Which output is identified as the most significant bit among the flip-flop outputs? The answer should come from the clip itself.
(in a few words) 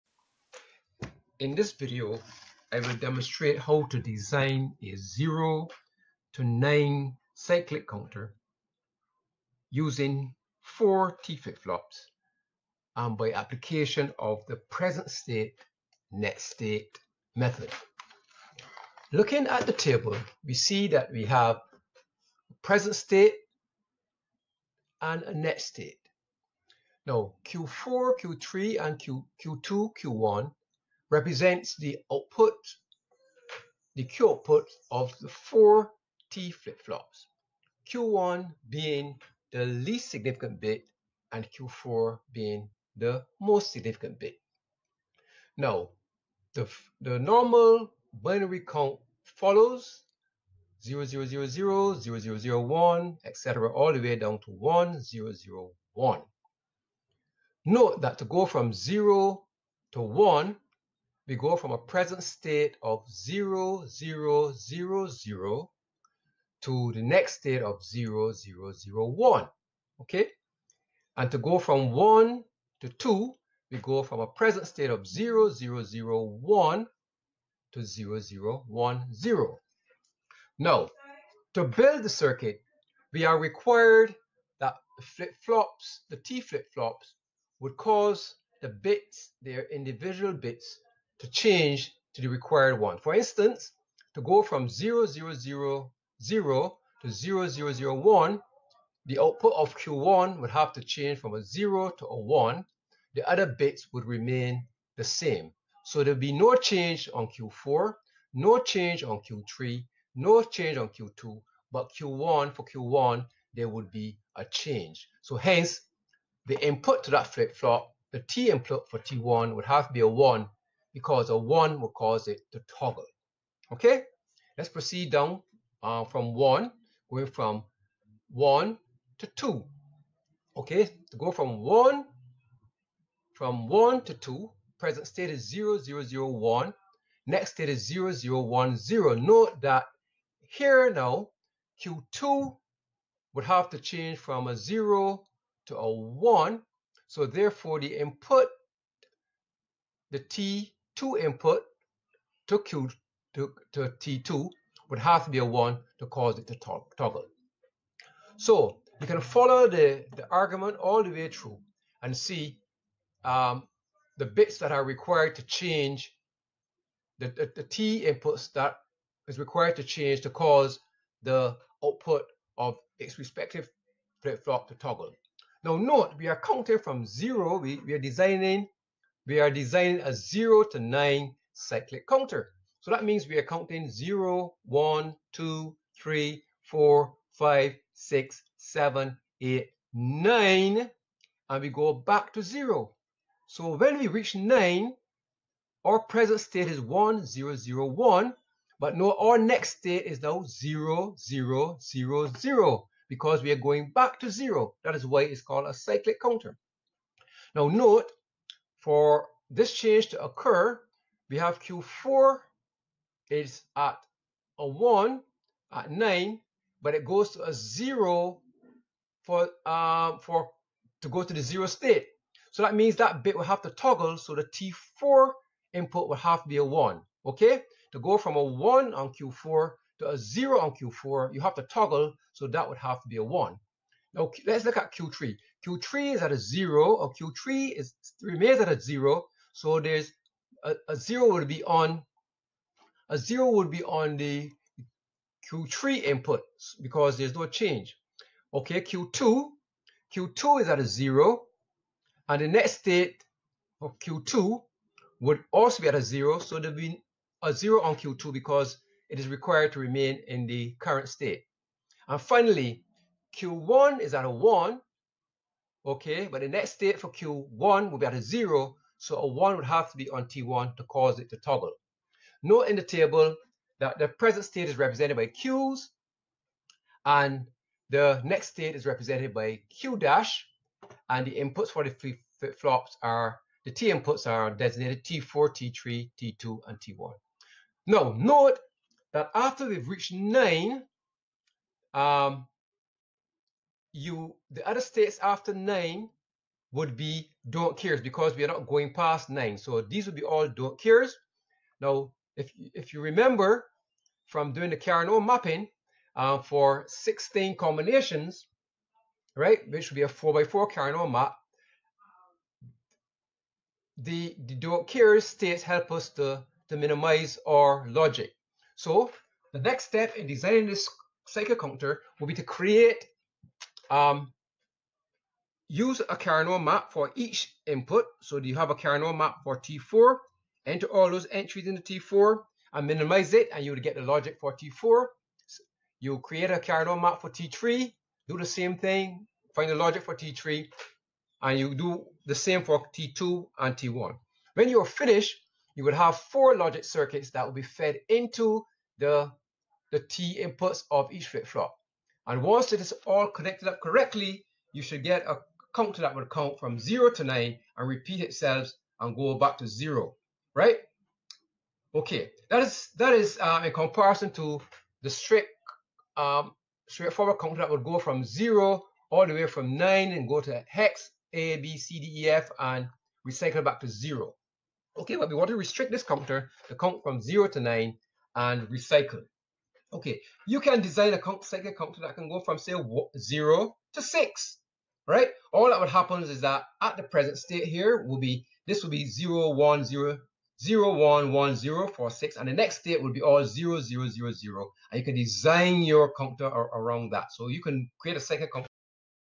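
Q4.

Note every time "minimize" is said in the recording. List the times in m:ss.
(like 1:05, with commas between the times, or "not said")
5:16, 5:32.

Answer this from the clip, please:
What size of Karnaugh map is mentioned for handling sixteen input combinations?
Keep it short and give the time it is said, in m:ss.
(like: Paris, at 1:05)
4 by 4, at 5:10.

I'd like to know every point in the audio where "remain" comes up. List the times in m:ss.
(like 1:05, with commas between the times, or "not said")
1:44, 3:58, 4:19.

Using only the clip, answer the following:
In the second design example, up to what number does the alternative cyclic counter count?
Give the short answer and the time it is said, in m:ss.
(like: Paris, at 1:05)
6, at 6:23.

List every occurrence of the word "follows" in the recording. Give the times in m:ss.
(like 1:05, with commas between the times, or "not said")
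0:49, 2:39.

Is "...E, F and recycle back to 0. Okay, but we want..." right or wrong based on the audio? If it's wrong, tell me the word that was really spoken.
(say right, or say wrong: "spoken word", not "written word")
right.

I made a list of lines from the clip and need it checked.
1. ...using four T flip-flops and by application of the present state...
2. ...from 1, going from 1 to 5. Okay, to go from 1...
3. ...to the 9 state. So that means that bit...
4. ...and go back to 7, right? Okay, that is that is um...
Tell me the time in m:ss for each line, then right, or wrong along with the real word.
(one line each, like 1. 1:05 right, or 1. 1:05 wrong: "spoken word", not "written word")
1. 0:09 right
2. 2:06 wrong: "2", not "5"
3. 3:41 wrong: "0", not "9"
4. 5:58 wrong: "0", not "7".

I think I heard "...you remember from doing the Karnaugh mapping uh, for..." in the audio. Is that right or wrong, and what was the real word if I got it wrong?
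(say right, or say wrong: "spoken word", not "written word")
right.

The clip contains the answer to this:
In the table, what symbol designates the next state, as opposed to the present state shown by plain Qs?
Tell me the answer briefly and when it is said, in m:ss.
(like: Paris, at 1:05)
Q dash, at 4:39.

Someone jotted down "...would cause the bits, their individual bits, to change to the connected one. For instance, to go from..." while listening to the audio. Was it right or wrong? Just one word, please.
wrong.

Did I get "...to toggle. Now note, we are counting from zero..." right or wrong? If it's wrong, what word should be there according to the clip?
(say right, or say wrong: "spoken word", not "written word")
right.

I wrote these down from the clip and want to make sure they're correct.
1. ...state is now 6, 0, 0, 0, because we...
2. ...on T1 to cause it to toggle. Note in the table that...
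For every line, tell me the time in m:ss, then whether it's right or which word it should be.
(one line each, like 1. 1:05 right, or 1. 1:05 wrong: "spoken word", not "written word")
1. 3:19 wrong: "0", not "6"
2. 4:30 right.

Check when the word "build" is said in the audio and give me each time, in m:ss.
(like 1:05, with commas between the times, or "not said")
1:21.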